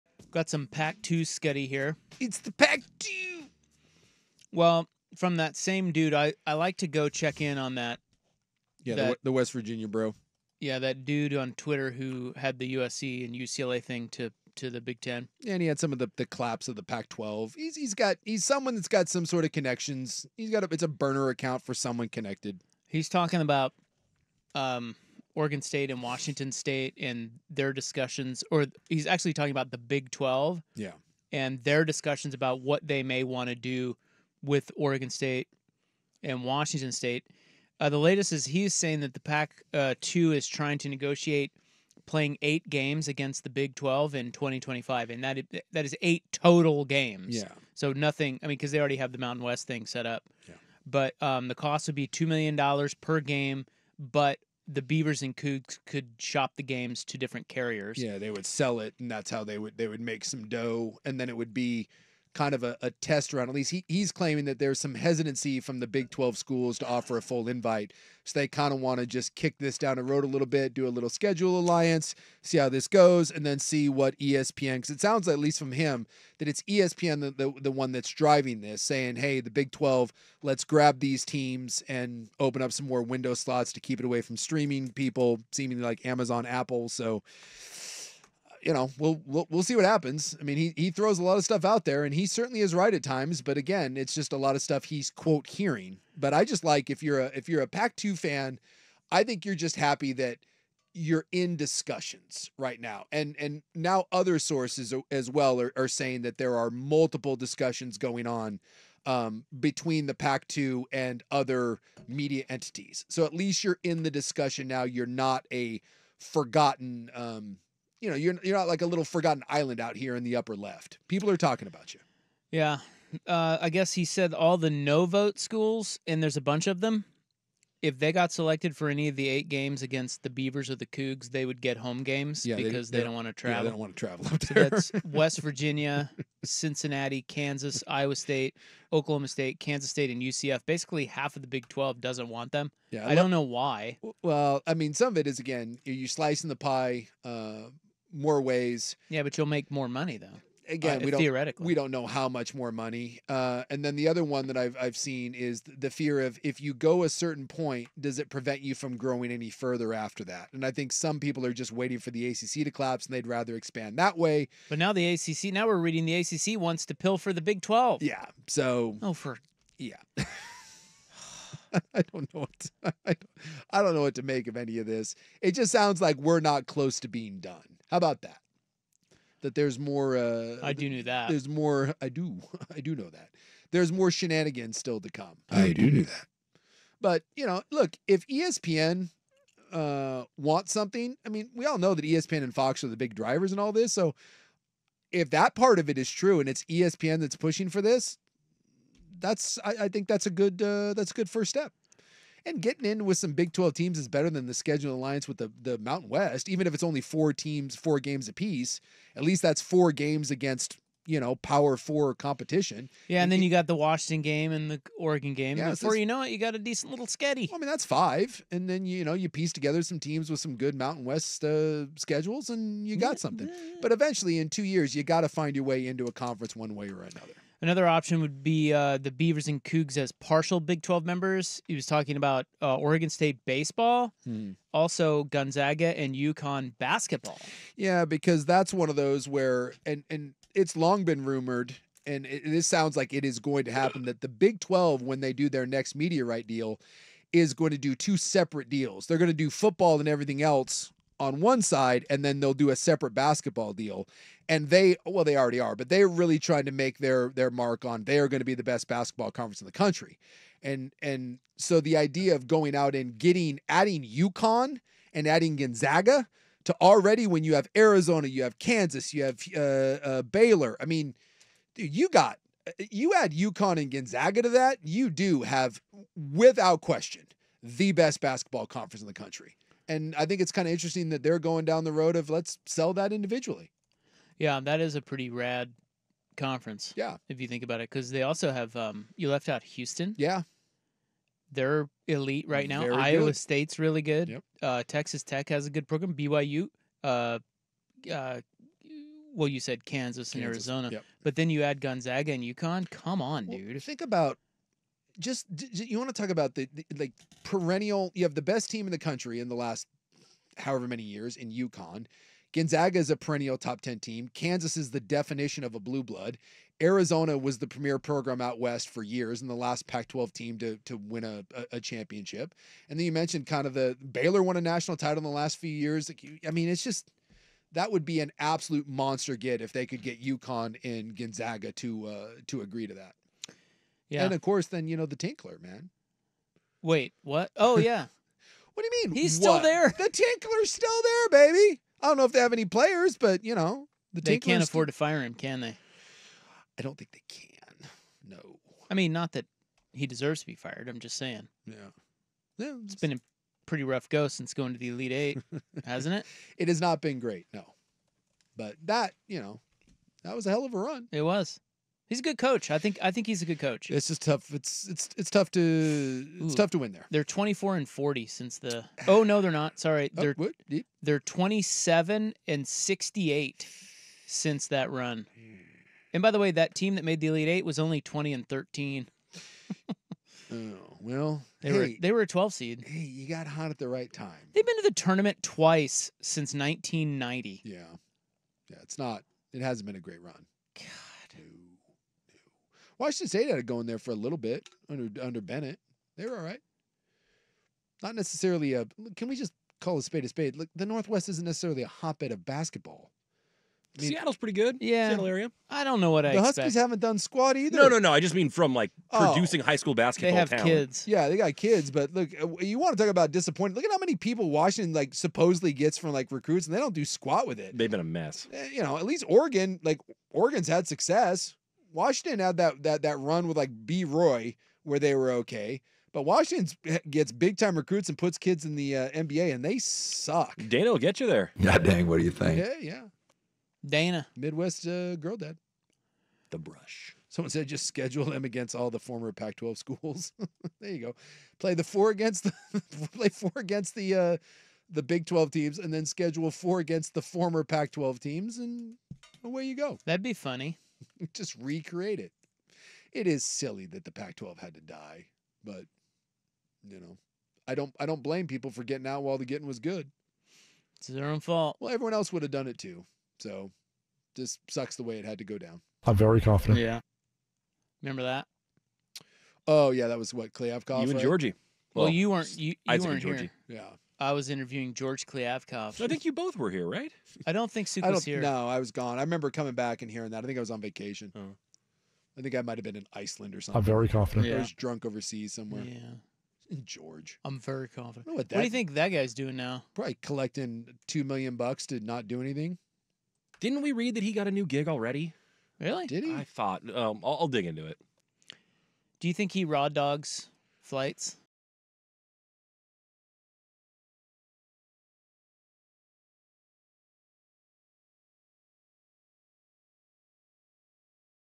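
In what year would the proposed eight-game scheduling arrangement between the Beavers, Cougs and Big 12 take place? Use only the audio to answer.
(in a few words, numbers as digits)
2025.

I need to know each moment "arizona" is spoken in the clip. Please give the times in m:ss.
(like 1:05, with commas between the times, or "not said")
4:27, 5:00, 5:16.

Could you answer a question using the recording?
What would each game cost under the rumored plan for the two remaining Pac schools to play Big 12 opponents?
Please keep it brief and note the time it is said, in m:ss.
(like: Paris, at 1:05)
$2 million, at 0:52.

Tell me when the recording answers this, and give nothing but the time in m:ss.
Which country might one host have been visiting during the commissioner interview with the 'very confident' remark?
8:03.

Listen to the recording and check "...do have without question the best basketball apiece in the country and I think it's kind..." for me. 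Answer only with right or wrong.
wrong.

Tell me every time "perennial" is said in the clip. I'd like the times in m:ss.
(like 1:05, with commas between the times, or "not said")
5:07, 5:13.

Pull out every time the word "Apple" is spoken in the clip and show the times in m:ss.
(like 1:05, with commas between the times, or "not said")
1:26.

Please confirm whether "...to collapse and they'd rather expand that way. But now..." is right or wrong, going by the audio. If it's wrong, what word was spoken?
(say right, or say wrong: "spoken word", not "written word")
right.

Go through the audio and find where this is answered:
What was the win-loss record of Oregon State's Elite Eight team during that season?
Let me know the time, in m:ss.
6:18.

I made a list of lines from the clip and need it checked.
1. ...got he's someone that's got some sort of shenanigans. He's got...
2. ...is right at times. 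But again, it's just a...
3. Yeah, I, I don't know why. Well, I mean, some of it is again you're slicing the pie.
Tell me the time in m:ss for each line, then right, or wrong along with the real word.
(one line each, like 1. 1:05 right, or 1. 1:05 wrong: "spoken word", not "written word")
1. 0:17 wrong: "connections", not "shenanigans"
2. 1:32 right
3. 2:22 right.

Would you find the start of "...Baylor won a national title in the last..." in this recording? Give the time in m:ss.
5:24.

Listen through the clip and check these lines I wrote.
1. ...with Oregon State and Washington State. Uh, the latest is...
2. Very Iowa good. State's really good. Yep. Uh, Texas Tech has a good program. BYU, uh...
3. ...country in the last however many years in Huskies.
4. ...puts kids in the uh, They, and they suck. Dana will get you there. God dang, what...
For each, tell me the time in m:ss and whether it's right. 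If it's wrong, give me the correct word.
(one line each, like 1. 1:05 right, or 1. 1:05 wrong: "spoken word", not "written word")
1. 0:34 right
2. 4:52 right
3. 5:08 wrong: "UConn", not "Huskies"
4. 7:08 wrong: "NBA", not "They".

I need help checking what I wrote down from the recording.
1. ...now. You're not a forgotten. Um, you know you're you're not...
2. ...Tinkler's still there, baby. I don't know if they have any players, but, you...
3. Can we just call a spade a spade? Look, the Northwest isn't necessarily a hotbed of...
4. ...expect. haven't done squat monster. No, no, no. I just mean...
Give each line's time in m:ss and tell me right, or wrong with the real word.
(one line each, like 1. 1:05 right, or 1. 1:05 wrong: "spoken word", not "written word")
1. 1:54 right
2. 5:40 right
3. 6:39 right
4. 6:46 wrong: "either", not "monster".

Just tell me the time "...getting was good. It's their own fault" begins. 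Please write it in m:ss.
7:39.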